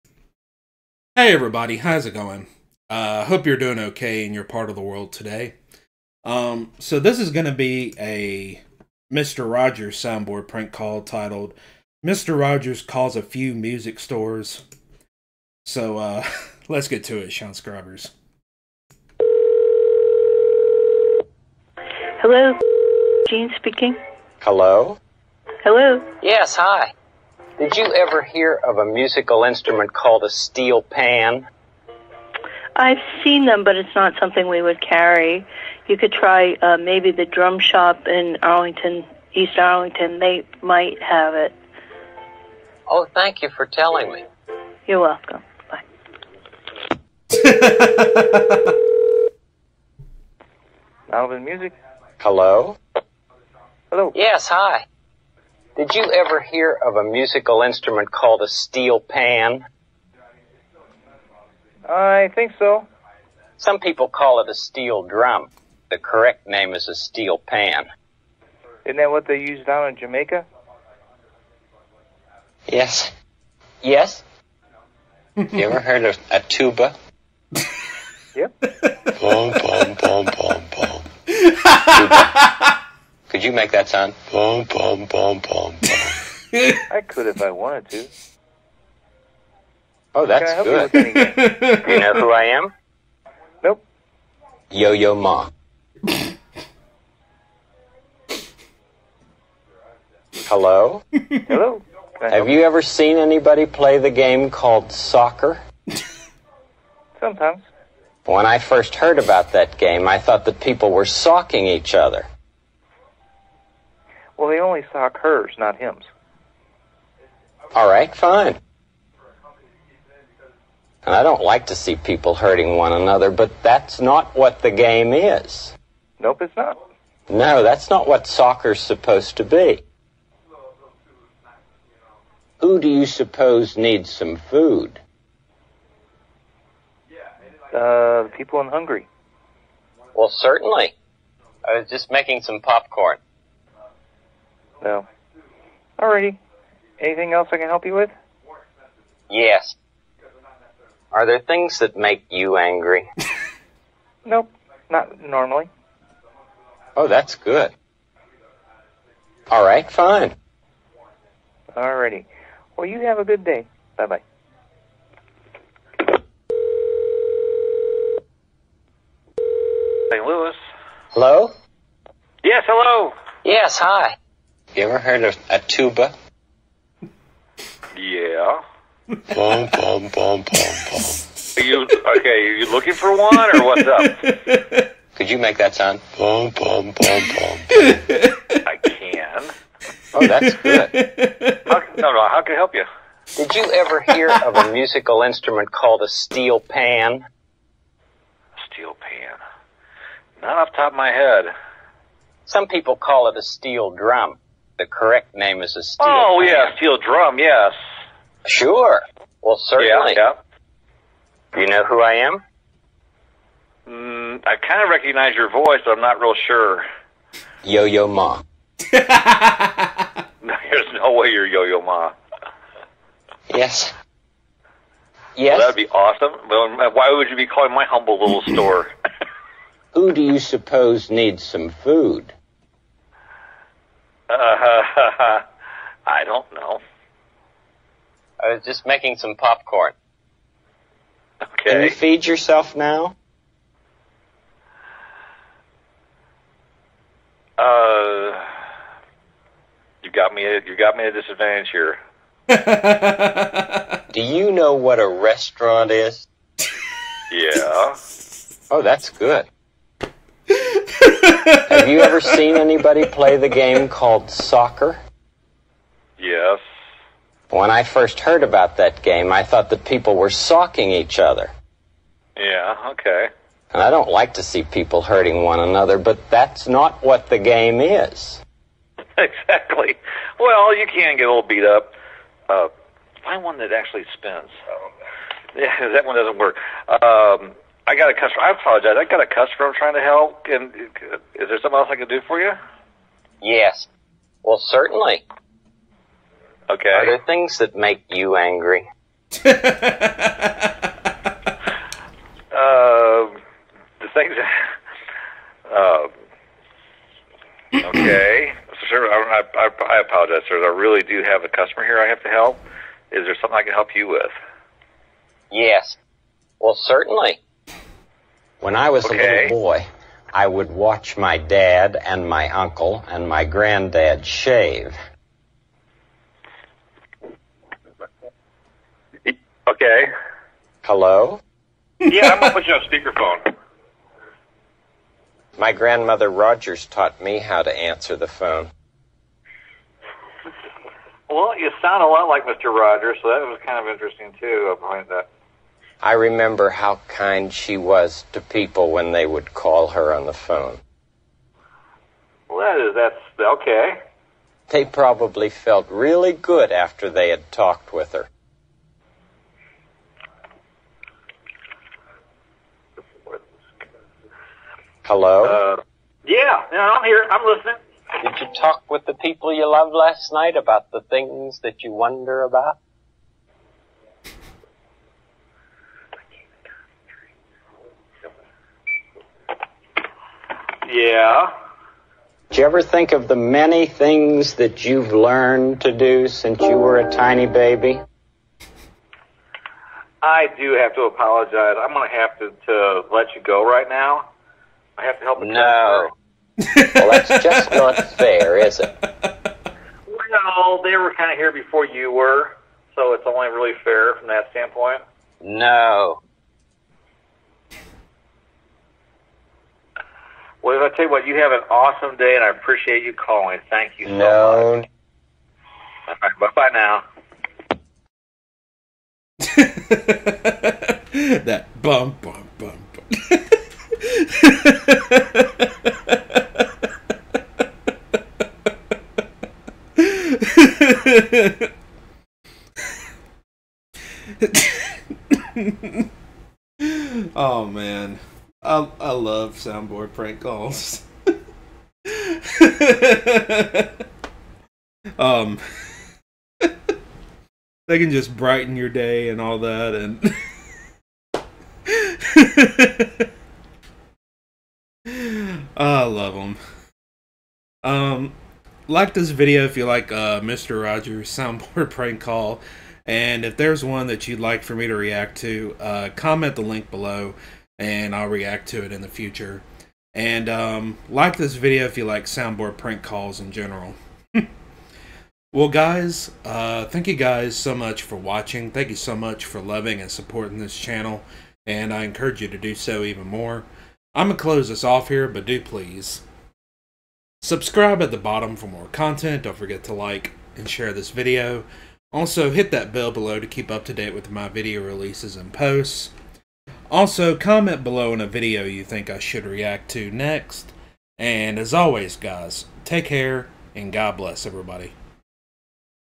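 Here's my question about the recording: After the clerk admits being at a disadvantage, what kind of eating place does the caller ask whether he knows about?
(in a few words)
restaurant.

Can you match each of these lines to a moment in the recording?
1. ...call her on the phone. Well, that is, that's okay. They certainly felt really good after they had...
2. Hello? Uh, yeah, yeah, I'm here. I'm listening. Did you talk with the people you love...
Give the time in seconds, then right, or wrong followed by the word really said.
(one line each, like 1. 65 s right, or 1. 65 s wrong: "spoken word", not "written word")
1. 349 s wrong: "probably", not "certainly"
2. 365 s right.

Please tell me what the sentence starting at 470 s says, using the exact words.
And um, like this video if you like soundboard prank calls in general.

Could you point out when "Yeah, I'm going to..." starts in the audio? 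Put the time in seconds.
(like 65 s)
331 s.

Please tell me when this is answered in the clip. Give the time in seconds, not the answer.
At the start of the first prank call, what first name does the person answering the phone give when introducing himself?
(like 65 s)
23 s.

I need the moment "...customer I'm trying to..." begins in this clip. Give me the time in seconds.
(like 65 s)
289 s.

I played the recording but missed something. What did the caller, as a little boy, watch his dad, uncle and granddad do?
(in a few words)
shave.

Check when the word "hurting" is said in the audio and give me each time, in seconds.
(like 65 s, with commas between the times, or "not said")
122 s, 275 s.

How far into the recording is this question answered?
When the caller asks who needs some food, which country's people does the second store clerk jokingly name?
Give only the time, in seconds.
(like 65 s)
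138 s.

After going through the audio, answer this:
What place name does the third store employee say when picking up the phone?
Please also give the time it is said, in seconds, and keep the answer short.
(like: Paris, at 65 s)
St. Louis, at 170 s.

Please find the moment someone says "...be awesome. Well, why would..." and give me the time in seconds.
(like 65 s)
225 s.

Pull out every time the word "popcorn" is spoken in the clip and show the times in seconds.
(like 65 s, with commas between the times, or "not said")
142 s, 239 s.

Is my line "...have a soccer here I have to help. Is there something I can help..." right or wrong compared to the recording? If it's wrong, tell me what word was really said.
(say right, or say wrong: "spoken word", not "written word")
wrong: "customer", not "soccer".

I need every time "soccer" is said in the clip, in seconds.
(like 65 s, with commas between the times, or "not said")
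104 s, 128 s, 264 s.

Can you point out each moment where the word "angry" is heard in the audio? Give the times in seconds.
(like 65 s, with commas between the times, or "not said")
152 s, 298 s.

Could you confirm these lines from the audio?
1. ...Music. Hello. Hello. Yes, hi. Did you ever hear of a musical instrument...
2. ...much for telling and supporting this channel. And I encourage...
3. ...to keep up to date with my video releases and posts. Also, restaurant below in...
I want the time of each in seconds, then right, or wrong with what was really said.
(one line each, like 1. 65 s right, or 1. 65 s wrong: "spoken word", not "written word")
1. 51 s right
2. 479 s wrong: "loving", not "telling"
3. 493 s wrong: "comment", not "restaurant".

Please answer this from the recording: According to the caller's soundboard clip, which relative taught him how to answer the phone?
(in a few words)
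grandmother Rogers.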